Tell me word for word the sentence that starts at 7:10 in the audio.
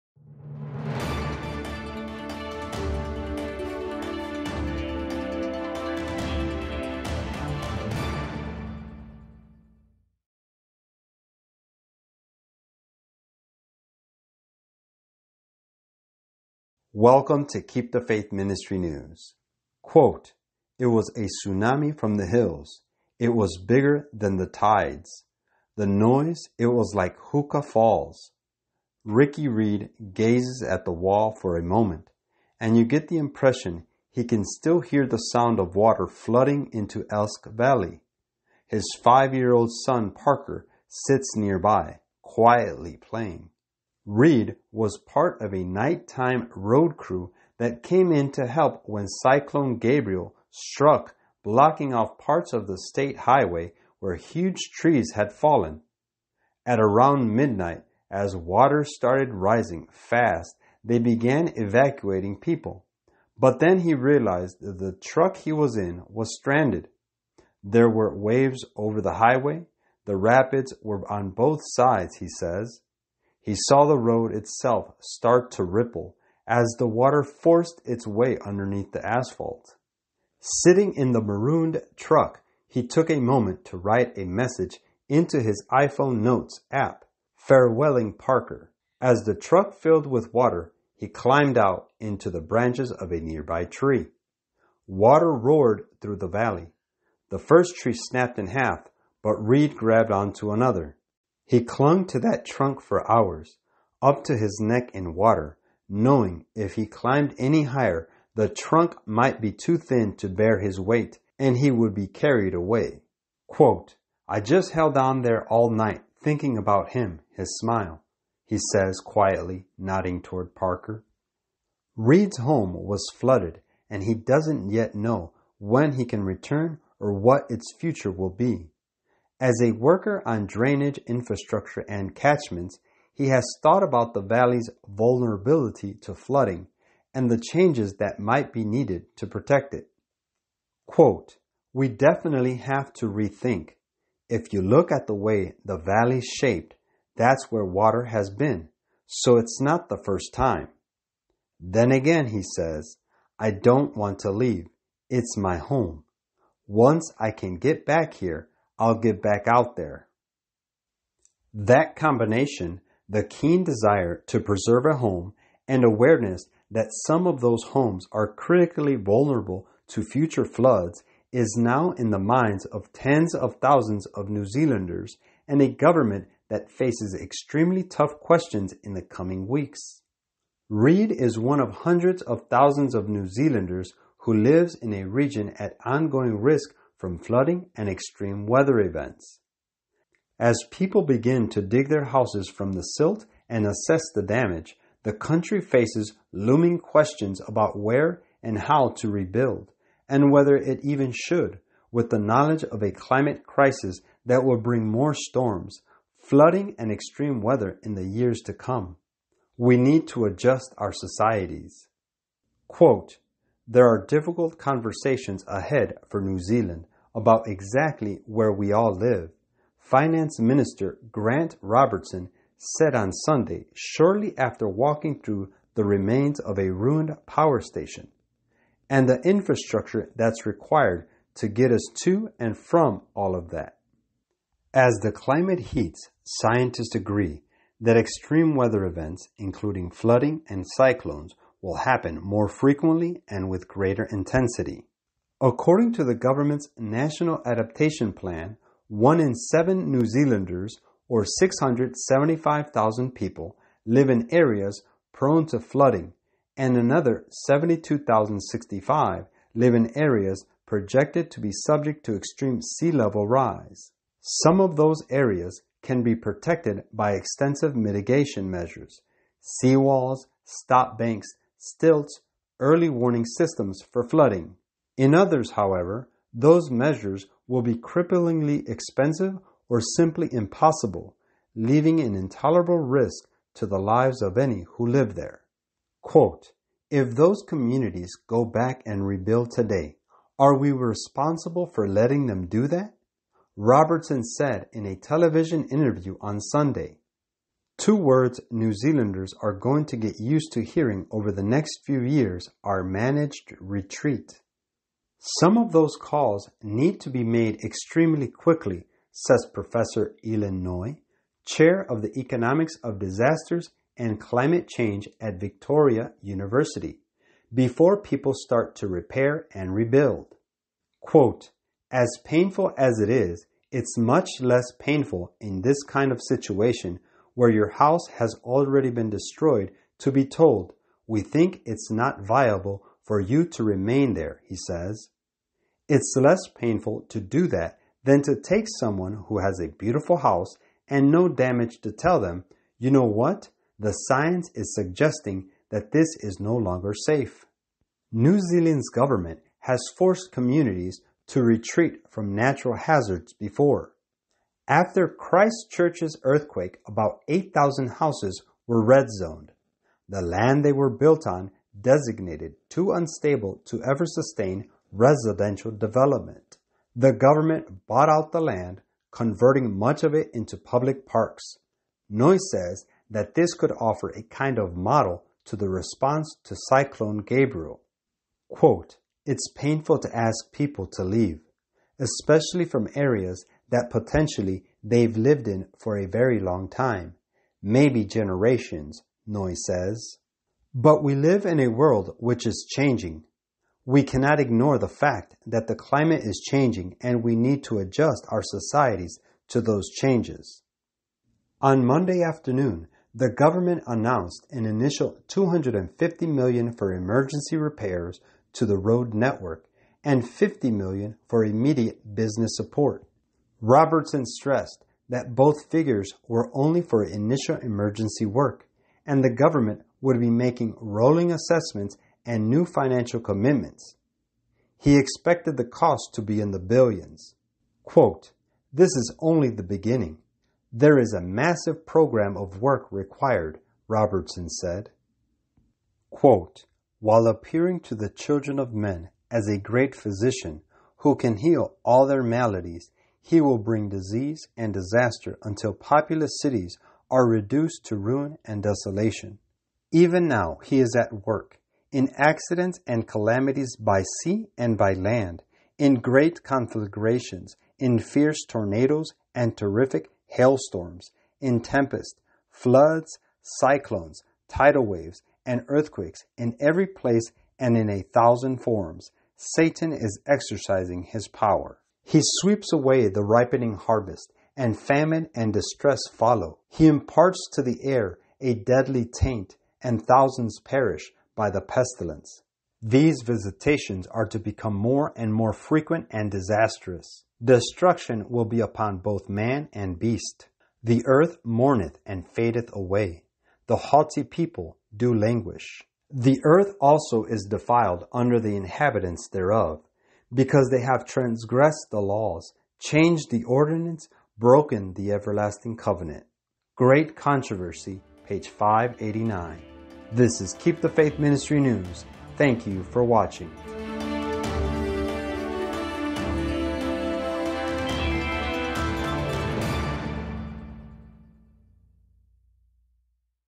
There is a massive program of work required, Robertson said.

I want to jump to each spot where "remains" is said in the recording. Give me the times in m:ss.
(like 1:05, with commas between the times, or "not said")
3:45, 5:33.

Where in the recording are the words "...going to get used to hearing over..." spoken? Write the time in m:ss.
4:59.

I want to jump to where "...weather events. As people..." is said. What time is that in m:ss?
3:08.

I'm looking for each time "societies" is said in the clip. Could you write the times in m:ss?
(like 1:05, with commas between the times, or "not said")
3:30, 6:38.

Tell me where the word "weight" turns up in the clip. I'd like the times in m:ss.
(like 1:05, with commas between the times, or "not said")
1:50.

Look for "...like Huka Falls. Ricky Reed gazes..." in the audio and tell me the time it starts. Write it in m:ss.
0:26.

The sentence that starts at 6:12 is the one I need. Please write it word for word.
Noy says that this could offer a kind of model to the response to Cyclone Gabrielle.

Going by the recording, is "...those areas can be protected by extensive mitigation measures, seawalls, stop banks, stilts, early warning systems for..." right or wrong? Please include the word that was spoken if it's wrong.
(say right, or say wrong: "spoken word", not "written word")
right.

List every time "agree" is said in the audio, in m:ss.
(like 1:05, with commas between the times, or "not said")
3:56.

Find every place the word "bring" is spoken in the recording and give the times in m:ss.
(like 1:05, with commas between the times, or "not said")
3:24, 7:23.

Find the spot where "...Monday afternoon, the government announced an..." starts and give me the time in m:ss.
6:41.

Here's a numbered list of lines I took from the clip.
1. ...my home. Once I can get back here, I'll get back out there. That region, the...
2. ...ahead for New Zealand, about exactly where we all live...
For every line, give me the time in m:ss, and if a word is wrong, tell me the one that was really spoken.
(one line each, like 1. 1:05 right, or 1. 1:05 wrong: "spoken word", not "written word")
1. 2:35 wrong: "combination", not "region"
2. 3:35 right.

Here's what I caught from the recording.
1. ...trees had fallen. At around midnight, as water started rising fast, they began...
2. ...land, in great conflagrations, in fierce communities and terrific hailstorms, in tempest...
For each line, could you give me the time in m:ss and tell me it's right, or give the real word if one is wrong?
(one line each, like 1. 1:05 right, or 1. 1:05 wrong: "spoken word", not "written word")
1. 0:54 right
2. 7:34 wrong: "tornadoes", not "communities".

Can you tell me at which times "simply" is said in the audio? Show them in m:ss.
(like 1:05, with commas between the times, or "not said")
4:39.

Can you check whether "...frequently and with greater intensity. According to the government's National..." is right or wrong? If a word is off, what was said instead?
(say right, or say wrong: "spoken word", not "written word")
right.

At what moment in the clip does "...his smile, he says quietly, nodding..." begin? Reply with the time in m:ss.
1:57.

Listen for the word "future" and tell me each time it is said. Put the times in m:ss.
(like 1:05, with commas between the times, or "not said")
2:07, 2:50.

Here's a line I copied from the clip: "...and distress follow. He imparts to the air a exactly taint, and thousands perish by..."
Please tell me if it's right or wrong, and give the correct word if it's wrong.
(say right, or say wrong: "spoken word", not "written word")
wrong: "deadly", not "exactly".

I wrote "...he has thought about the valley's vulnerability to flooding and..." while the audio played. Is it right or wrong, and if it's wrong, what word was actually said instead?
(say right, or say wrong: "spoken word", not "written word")
right.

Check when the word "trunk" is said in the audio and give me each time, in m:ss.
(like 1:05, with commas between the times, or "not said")
1:42, 1:48.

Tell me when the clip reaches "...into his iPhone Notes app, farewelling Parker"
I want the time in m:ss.
1:25.